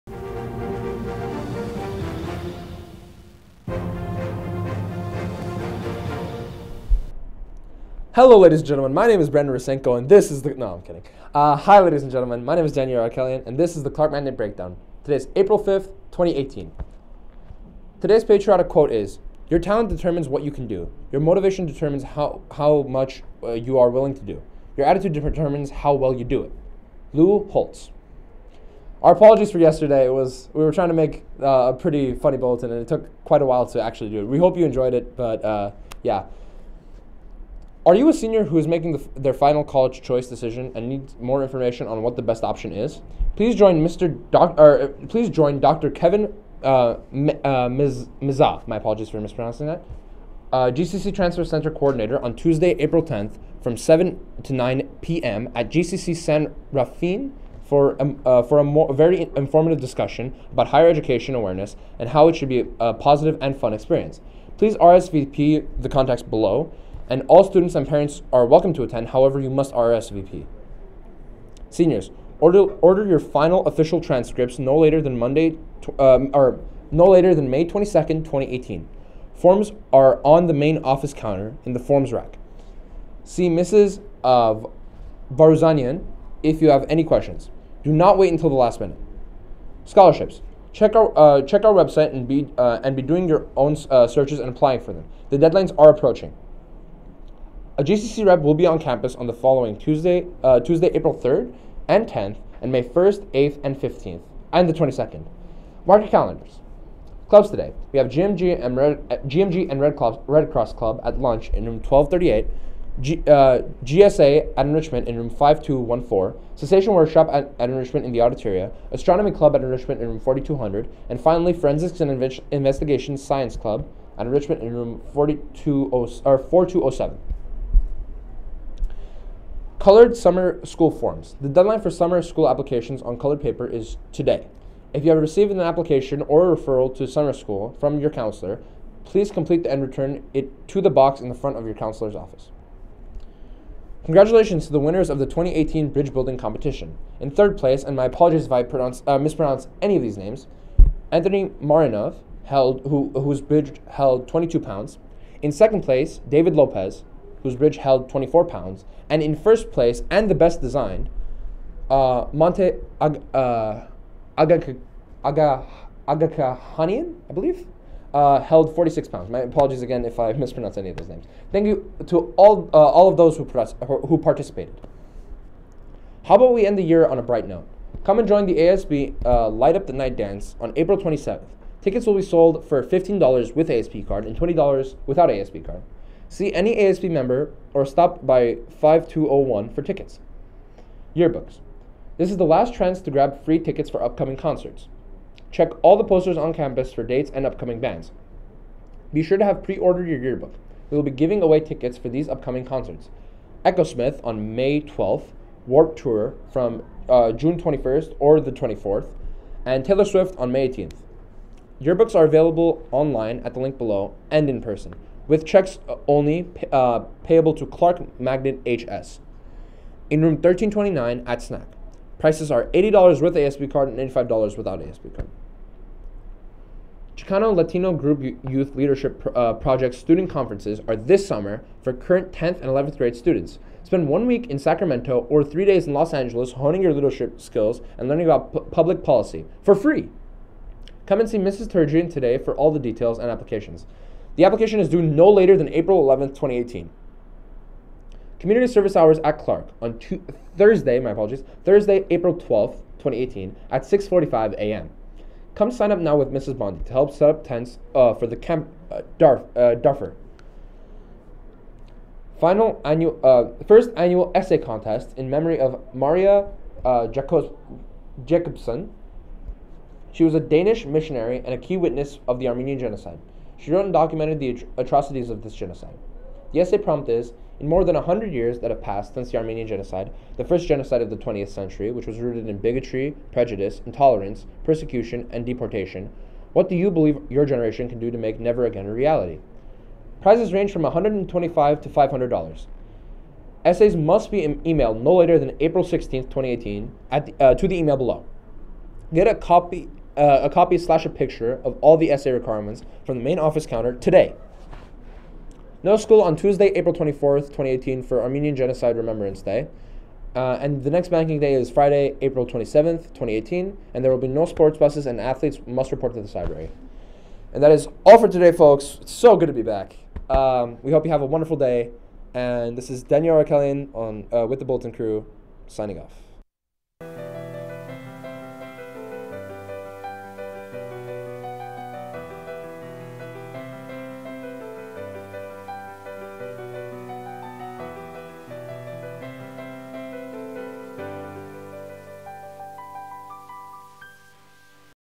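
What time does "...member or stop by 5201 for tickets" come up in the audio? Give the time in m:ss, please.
3:07.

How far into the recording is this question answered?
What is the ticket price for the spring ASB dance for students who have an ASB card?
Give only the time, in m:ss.
3:02.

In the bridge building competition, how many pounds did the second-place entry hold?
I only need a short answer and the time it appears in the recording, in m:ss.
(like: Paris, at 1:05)
24 pounds, at 2:38.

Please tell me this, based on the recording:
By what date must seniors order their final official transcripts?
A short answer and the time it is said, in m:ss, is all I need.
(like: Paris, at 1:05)
May 22nd, 2018, at 1:17.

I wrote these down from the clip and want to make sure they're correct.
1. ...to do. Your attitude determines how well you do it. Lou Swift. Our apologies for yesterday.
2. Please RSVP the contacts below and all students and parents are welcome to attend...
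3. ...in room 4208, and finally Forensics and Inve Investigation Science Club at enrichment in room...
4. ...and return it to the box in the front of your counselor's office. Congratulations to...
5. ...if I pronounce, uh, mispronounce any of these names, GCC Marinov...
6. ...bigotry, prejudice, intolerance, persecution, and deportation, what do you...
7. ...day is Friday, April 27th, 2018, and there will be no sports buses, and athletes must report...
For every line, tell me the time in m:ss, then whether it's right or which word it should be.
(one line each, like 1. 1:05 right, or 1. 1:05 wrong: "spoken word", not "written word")
1. 0:24 wrong: "Holtz", not "Swift"
2. 1:04 right
3. 2:00 wrong: "4200", not "4208"
4. 2:19 right
5. 2:28 wrong: "Anthony", not "GCC"
6. 4:42 right
7. 5:11 right.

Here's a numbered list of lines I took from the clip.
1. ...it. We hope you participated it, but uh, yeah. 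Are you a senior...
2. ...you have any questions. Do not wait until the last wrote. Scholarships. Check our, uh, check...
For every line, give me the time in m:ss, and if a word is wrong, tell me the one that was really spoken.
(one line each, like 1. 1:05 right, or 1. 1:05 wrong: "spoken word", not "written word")
1. 0:34 wrong: "enjoyed", not "participated"
2. 1:26 wrong: "minute", not "wrote".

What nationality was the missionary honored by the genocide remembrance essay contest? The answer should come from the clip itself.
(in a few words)
Danish.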